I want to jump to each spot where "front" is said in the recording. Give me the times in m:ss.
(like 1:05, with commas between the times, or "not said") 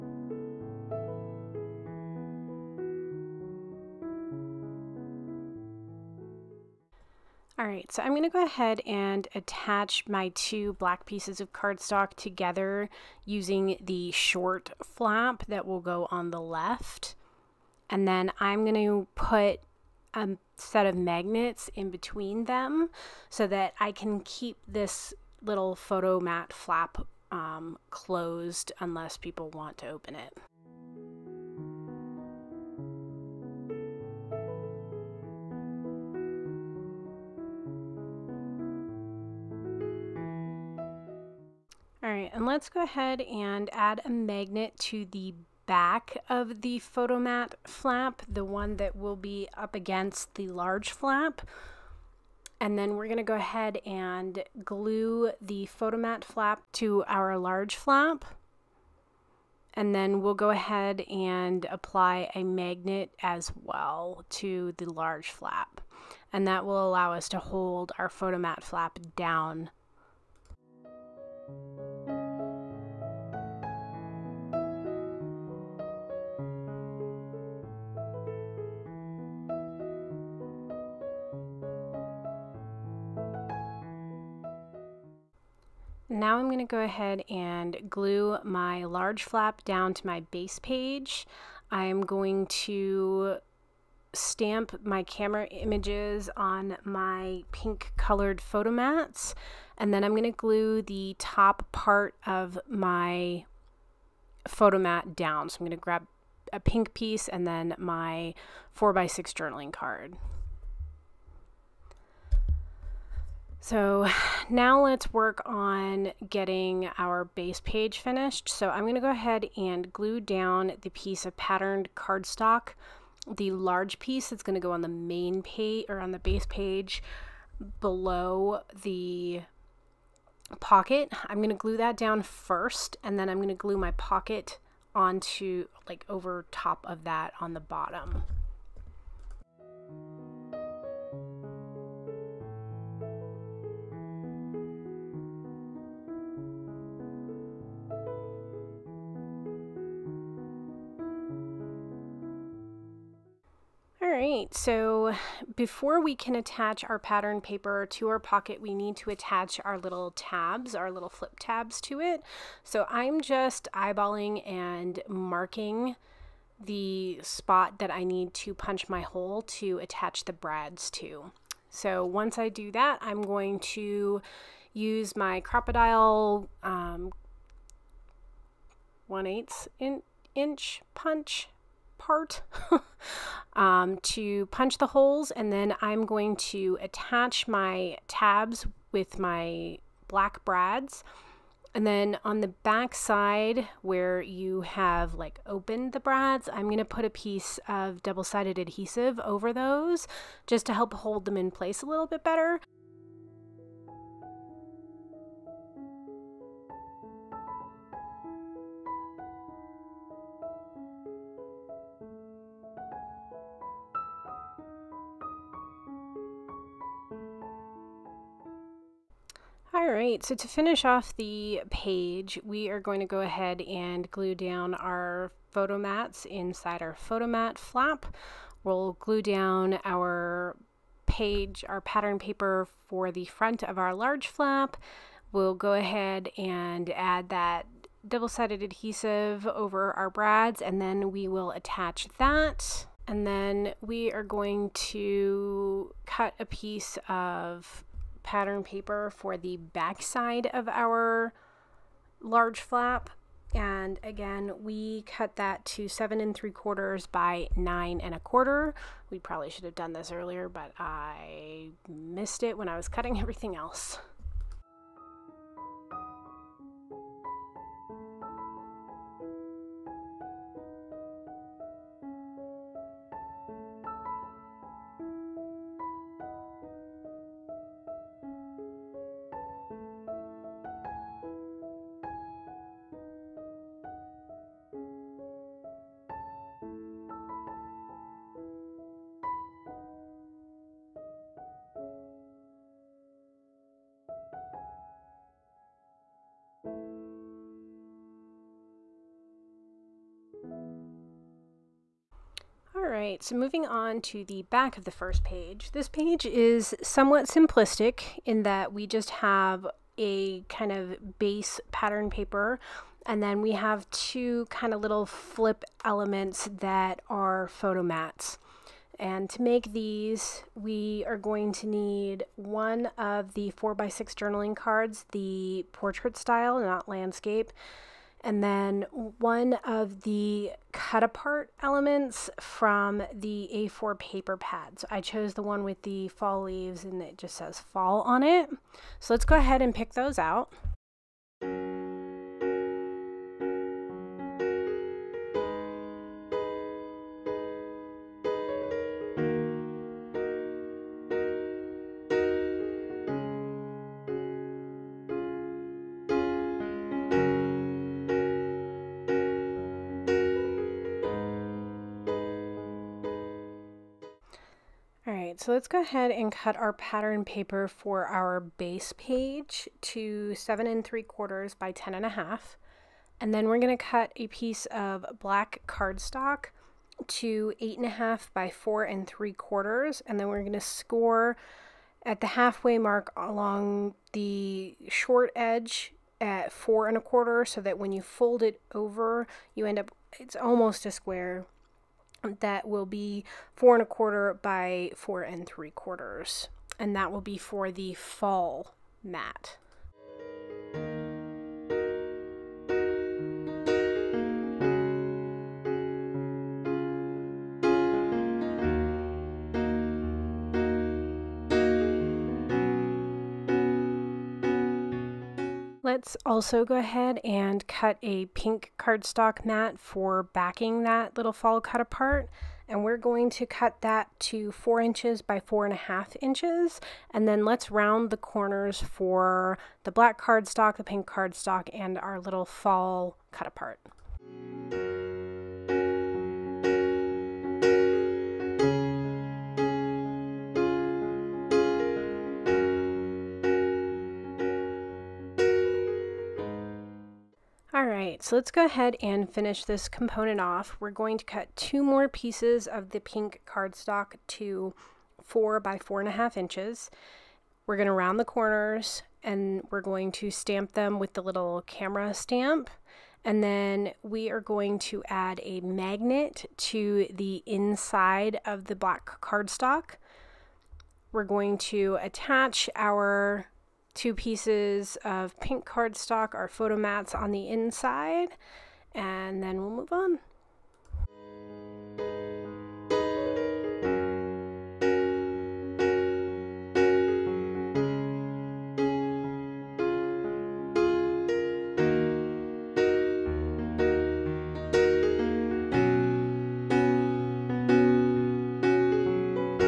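3:53.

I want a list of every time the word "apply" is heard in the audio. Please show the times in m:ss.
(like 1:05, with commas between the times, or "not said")
1:01.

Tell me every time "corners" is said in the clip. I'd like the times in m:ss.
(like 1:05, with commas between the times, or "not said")
7:08, 7:38.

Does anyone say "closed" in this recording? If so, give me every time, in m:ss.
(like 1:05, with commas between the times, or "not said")
0:27.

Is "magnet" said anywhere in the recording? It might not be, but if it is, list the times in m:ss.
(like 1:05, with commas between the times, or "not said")
0:20, 0:44, 1:02, 7:45.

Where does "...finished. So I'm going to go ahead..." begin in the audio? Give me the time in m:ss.
1:57.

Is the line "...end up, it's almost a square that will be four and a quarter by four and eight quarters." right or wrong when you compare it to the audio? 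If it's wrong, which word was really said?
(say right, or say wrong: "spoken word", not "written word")
wrong: "three", not "eight".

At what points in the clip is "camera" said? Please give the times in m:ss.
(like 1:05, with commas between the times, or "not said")
1:35, 7:41.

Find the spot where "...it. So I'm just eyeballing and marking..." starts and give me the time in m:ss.
2:41.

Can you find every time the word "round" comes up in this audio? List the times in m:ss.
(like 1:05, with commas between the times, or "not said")
7:07, 7:37.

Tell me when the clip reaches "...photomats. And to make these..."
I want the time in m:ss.
5:17.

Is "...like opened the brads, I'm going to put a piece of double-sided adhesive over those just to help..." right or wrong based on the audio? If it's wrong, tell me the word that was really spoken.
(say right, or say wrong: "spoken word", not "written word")
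right.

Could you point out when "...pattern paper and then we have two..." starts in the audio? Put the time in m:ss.
5:11.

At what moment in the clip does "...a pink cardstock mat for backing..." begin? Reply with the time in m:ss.
6:58.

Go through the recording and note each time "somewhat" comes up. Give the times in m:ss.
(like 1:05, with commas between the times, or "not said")
5:06.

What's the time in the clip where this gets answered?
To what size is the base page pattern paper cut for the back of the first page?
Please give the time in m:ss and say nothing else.
6:10.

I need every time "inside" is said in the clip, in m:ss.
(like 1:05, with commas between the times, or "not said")
3:46, 7:47, 7:57.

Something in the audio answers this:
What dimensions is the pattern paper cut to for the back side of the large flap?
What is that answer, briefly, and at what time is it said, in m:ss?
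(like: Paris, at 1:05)
7 3/4 by 9 1/4, at 4:15.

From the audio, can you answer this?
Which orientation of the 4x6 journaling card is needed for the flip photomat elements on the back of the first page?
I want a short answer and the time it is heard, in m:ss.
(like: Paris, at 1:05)
portrait, at 5:25.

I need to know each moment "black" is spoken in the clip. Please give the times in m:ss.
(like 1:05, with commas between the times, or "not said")
0:10, 3:10, 6:15, 7:09, 7:48.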